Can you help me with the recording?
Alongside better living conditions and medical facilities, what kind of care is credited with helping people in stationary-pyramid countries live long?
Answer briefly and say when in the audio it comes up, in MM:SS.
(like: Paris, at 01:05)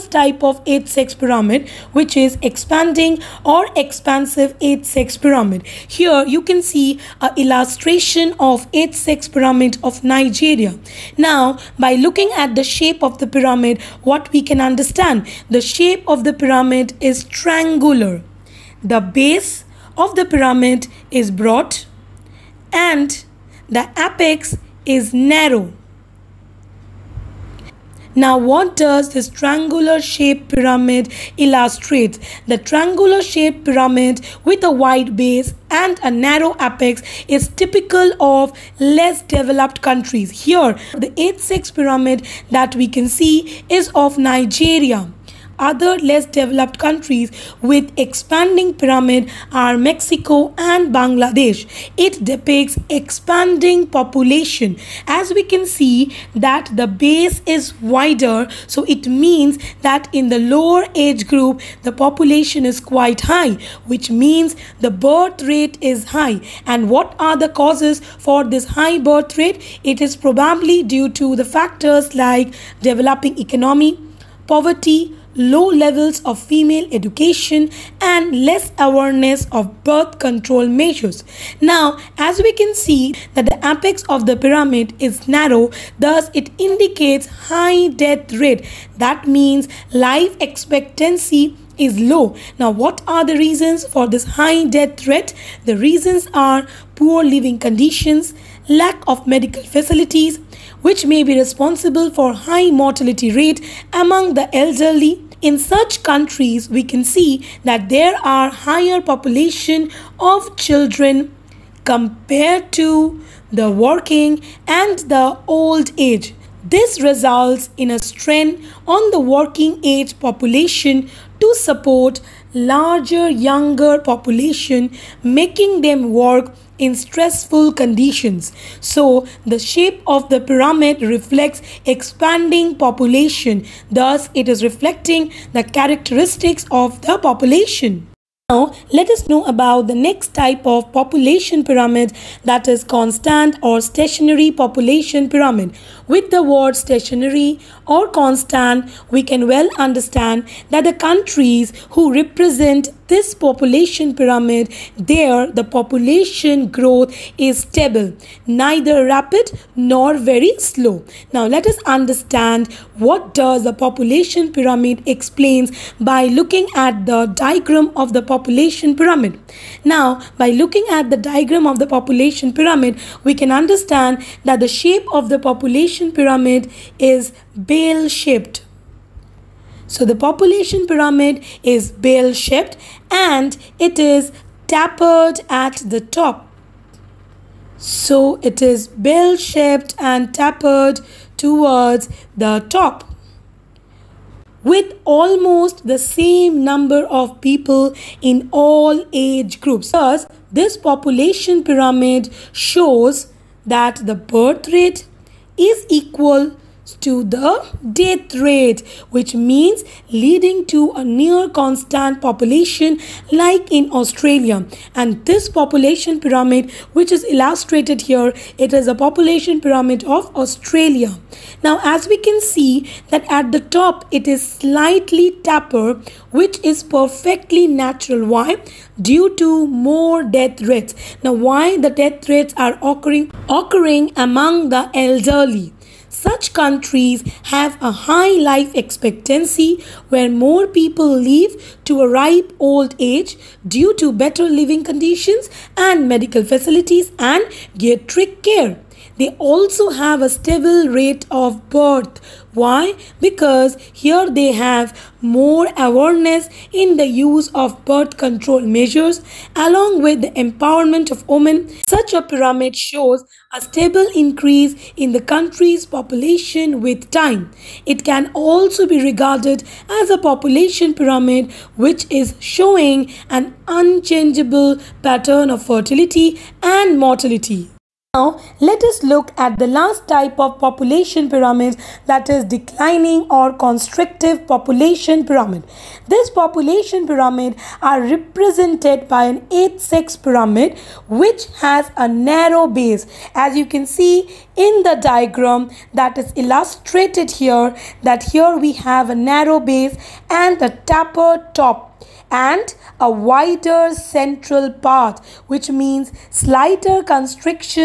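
Geriatric care, at 04:07.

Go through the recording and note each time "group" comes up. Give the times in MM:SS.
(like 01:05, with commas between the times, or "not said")
01:01, 03:19.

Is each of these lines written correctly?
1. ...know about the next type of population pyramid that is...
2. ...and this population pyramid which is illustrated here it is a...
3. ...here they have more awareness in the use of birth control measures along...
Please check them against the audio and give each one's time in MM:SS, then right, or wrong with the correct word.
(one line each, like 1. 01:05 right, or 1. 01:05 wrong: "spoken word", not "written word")
1. 02:19 right
2. 03:34 right
3. 04:14 right.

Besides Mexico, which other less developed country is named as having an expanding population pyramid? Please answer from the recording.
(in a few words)
Bangladesh.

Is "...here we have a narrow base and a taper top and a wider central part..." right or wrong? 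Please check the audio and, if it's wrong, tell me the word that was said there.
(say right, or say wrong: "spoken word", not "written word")
right.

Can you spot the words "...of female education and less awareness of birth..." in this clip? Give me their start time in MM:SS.
01:16.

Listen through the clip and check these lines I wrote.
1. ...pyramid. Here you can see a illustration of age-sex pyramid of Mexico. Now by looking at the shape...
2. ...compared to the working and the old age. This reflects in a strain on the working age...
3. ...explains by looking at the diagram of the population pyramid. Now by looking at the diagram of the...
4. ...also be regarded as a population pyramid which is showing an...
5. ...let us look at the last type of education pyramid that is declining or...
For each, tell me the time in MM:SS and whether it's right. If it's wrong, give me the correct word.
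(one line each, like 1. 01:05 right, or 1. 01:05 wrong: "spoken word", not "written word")
1. 00:05 wrong: "Nigeria", not "Mexico"
2. 01:51 wrong: "results", not "reflects"
3. 02:45 right
4. 04:28 right
5. 04:38 wrong: "population", not "education".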